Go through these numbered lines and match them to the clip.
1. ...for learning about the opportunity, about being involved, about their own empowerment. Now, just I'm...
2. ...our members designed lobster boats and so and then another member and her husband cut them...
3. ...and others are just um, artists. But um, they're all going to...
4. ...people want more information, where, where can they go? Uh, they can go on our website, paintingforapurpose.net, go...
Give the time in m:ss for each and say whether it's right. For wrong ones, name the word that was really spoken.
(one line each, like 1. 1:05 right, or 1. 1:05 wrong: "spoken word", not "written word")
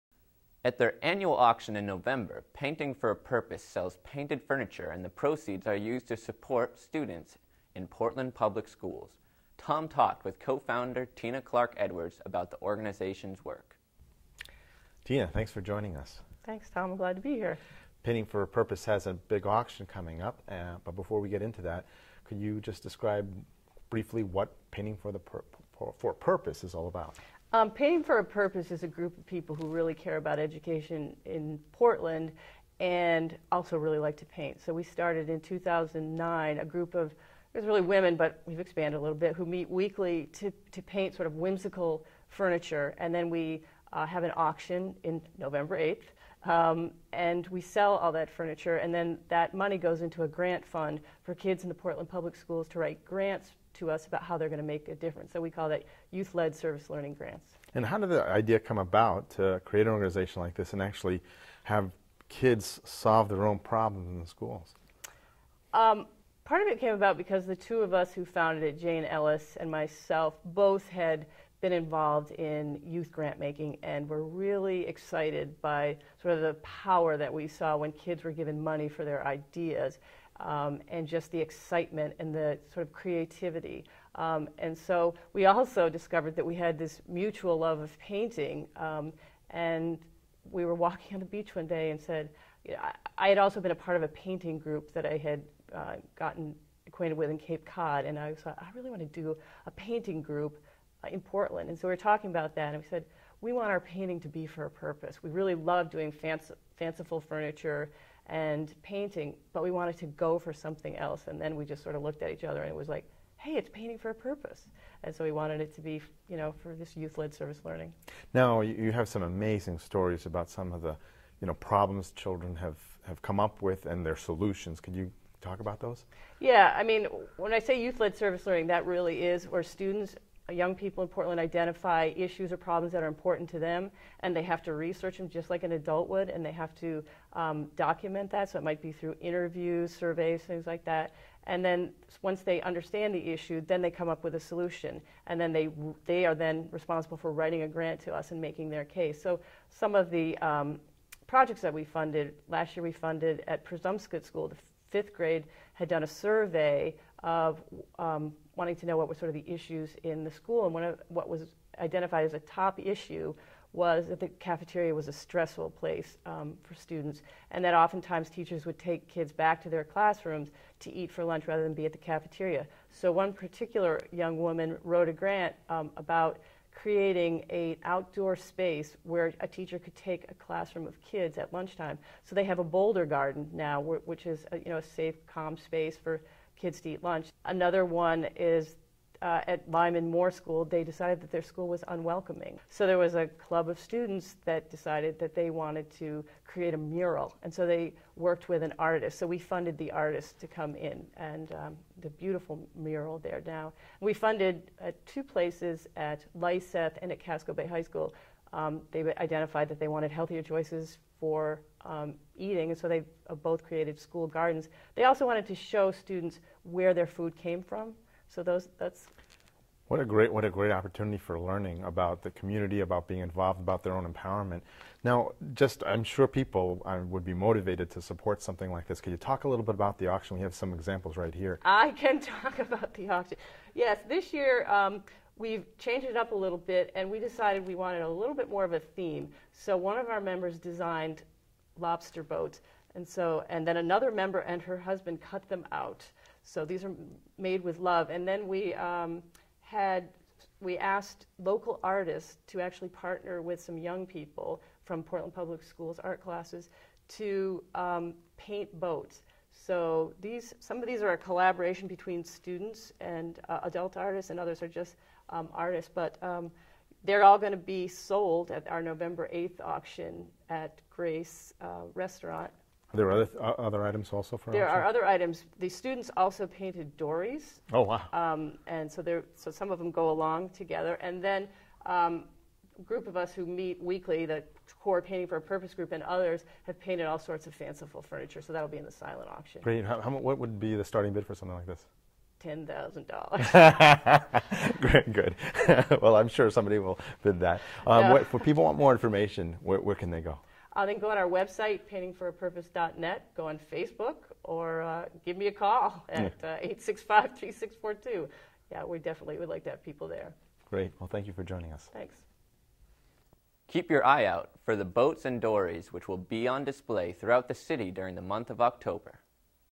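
1. 3:41 wrong: "community", not "opportunity"
2. 4:00 right
3. 4:24 right
4. 4:58 right.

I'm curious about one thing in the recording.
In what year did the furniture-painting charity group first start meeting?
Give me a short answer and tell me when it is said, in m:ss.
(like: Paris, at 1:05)
2009, at 0:35.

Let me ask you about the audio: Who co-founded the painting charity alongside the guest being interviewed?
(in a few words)
Jane Ellis.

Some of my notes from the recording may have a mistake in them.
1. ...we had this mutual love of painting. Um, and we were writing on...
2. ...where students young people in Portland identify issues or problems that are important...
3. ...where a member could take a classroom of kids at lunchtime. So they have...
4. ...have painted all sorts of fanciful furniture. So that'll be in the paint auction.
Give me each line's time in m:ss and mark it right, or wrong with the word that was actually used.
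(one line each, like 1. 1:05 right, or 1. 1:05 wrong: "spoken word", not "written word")
1. 1:26 wrong: "walking", not "writing"
2. 2:09 right
3. 2:59 wrong: "teacher", not "member"
4. 4:46 wrong: "silent", not "paint".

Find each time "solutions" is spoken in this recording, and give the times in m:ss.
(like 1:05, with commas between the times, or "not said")
2:04, 2:24.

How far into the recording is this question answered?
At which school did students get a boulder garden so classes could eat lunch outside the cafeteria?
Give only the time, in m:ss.
2:33.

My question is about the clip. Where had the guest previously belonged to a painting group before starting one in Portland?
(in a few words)
Cape Cod.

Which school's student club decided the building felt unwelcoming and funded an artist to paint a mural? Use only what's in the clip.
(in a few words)
Lyman Moore School.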